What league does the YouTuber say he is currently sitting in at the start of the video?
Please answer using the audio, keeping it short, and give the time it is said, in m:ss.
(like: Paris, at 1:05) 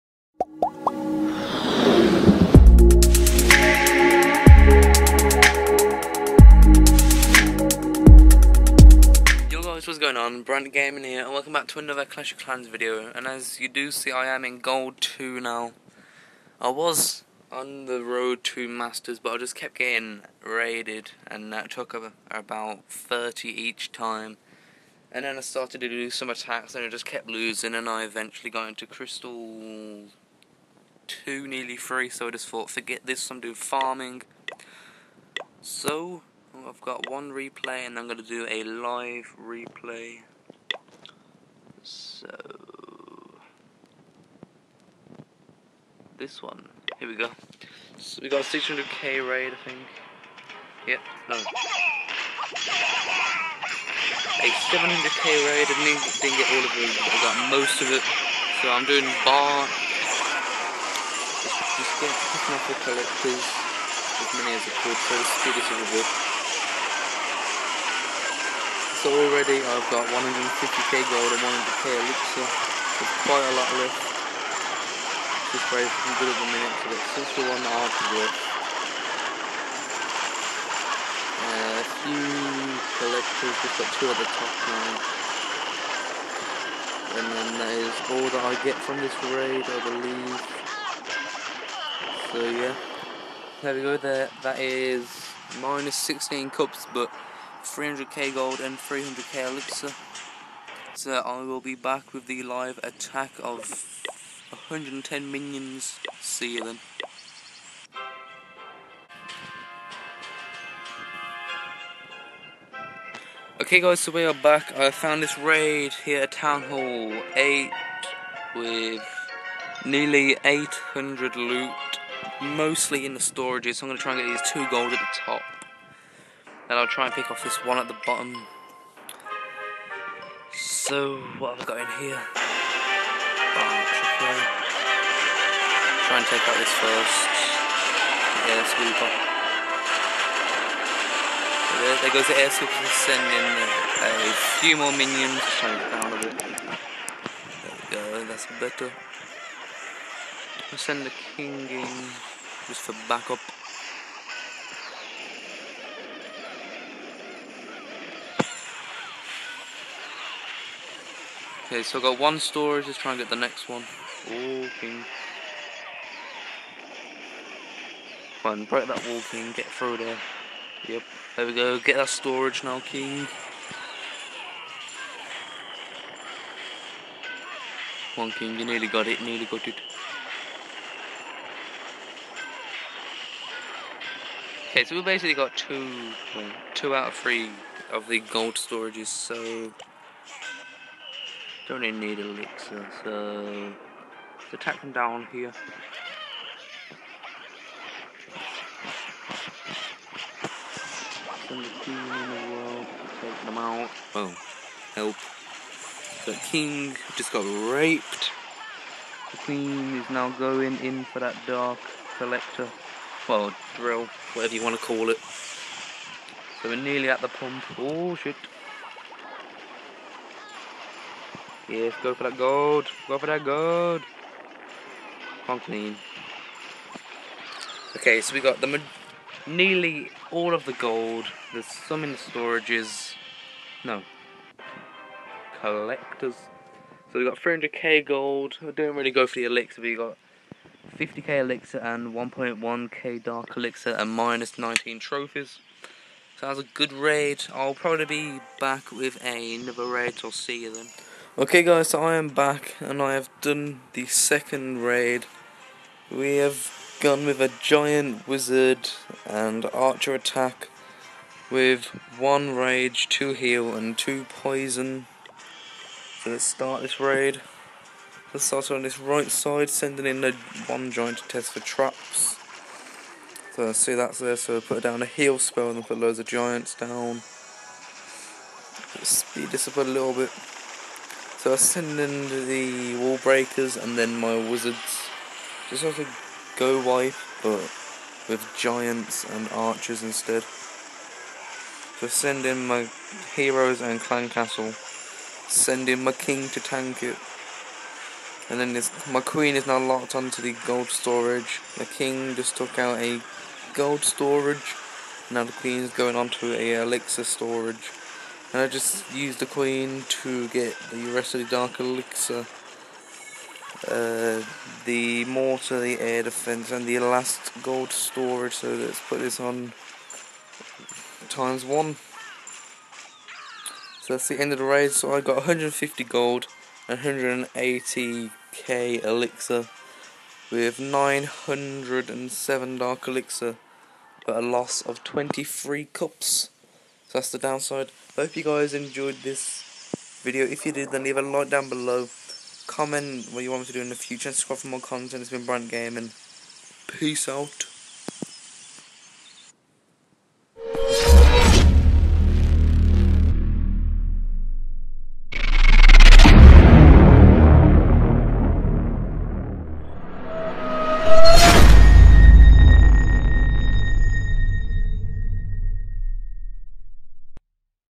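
Gold 2, at 0:14.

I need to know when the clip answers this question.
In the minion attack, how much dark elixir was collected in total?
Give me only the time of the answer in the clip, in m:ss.
4:02.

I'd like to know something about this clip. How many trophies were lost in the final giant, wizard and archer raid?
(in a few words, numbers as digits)
23.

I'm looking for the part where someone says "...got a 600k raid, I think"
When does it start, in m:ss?
0:48.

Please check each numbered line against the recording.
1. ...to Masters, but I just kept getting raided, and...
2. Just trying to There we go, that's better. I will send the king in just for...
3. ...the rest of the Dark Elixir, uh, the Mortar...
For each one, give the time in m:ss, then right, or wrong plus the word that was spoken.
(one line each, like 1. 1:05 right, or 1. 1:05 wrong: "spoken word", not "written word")
1. 0:18 right
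2. 2:25 right
3. 5:10 right.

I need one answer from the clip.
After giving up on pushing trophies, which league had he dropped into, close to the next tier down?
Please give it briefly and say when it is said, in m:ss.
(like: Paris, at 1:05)
Crystal 2, at 0:28.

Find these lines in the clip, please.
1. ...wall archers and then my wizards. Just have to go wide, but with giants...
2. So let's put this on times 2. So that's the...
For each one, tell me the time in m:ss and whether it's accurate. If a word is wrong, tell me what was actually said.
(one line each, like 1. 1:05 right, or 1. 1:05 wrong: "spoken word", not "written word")
1. 4:43 wrong: "breakers", not "archers"
2. 5:18 wrong: "1", not "2".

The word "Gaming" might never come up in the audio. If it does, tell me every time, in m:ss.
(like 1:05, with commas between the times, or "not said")
0:10, 5:45.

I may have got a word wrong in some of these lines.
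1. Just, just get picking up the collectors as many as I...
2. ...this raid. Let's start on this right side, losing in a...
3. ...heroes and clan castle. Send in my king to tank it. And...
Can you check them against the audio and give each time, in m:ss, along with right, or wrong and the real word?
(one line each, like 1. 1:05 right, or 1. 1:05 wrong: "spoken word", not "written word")
1. 1:01 right
2. 4:26 wrong: "sending", not "losing"
3. 4:53 right.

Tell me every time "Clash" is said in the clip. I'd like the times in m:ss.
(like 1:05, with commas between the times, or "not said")
0:12.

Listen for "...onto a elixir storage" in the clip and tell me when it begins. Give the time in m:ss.
5:06.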